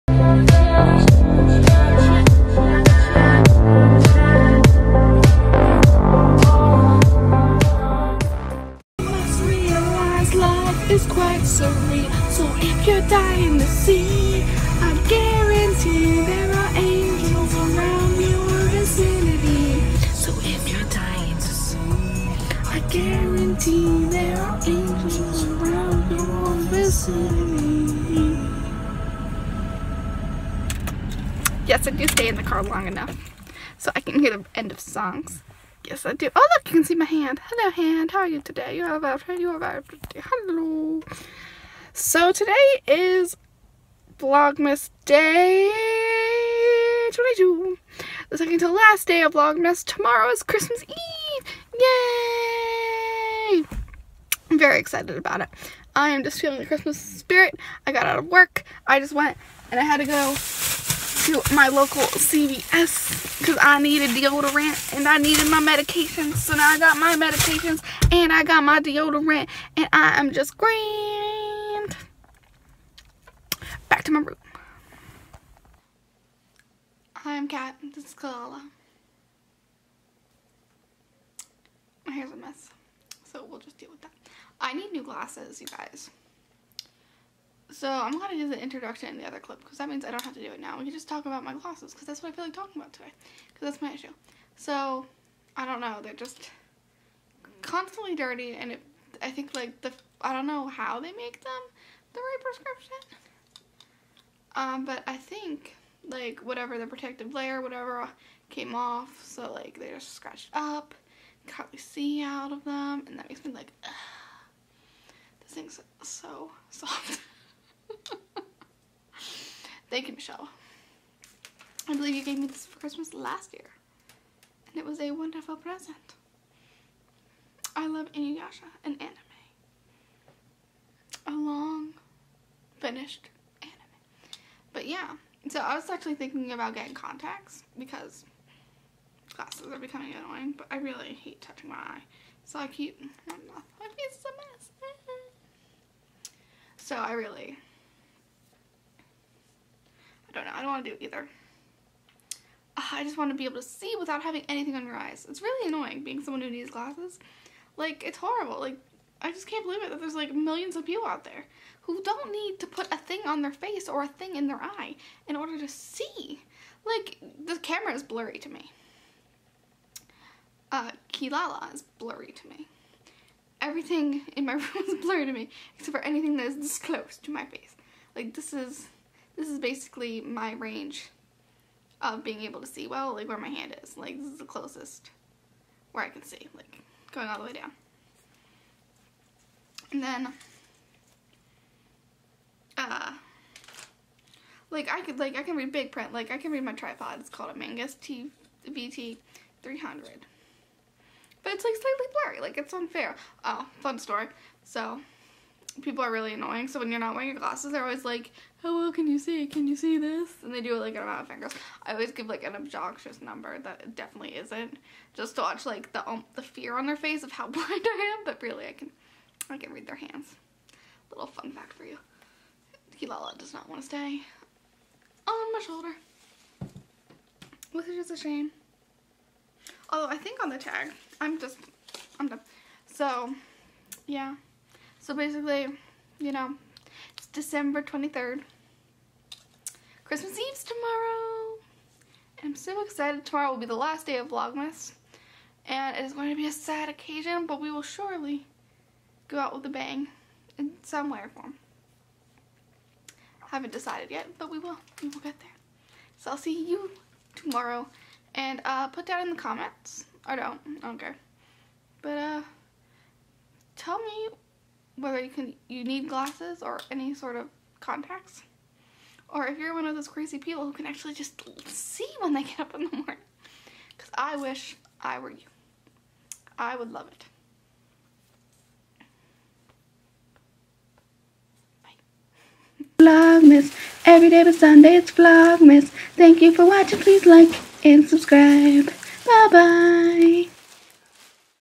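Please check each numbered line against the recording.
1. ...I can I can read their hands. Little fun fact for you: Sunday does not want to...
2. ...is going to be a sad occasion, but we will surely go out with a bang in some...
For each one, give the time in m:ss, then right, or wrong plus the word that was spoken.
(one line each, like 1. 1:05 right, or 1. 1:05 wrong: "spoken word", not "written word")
1. 3:38 wrong: "Kilala", not "Sunday"
2. 4:06 right.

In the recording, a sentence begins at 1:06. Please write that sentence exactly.
So now I got my medications and I got my deodorant and I am just grand.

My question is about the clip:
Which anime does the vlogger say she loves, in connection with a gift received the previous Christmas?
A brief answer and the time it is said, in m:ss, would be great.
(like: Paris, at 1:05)
Inuyasha, at 2:08.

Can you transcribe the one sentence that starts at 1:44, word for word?
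Um, but I think like whatever the protective layer, whatever came off.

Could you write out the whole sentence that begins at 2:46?
Like, the camera is blurry to me.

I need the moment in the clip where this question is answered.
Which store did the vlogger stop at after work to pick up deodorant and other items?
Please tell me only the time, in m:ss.
1:02.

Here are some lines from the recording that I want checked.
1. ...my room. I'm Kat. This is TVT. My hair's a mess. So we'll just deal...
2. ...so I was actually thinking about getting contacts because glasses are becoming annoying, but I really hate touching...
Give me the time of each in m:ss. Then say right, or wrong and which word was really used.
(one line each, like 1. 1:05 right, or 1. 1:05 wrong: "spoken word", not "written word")
1. 1:14 wrong: "Kilala", not "TVT"
2. 2:15 right.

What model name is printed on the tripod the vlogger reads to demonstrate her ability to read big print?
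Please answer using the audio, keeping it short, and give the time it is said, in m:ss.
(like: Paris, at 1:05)
Magnus TVT 300, at 3:17.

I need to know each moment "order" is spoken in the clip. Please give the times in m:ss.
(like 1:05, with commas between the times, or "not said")
2:45.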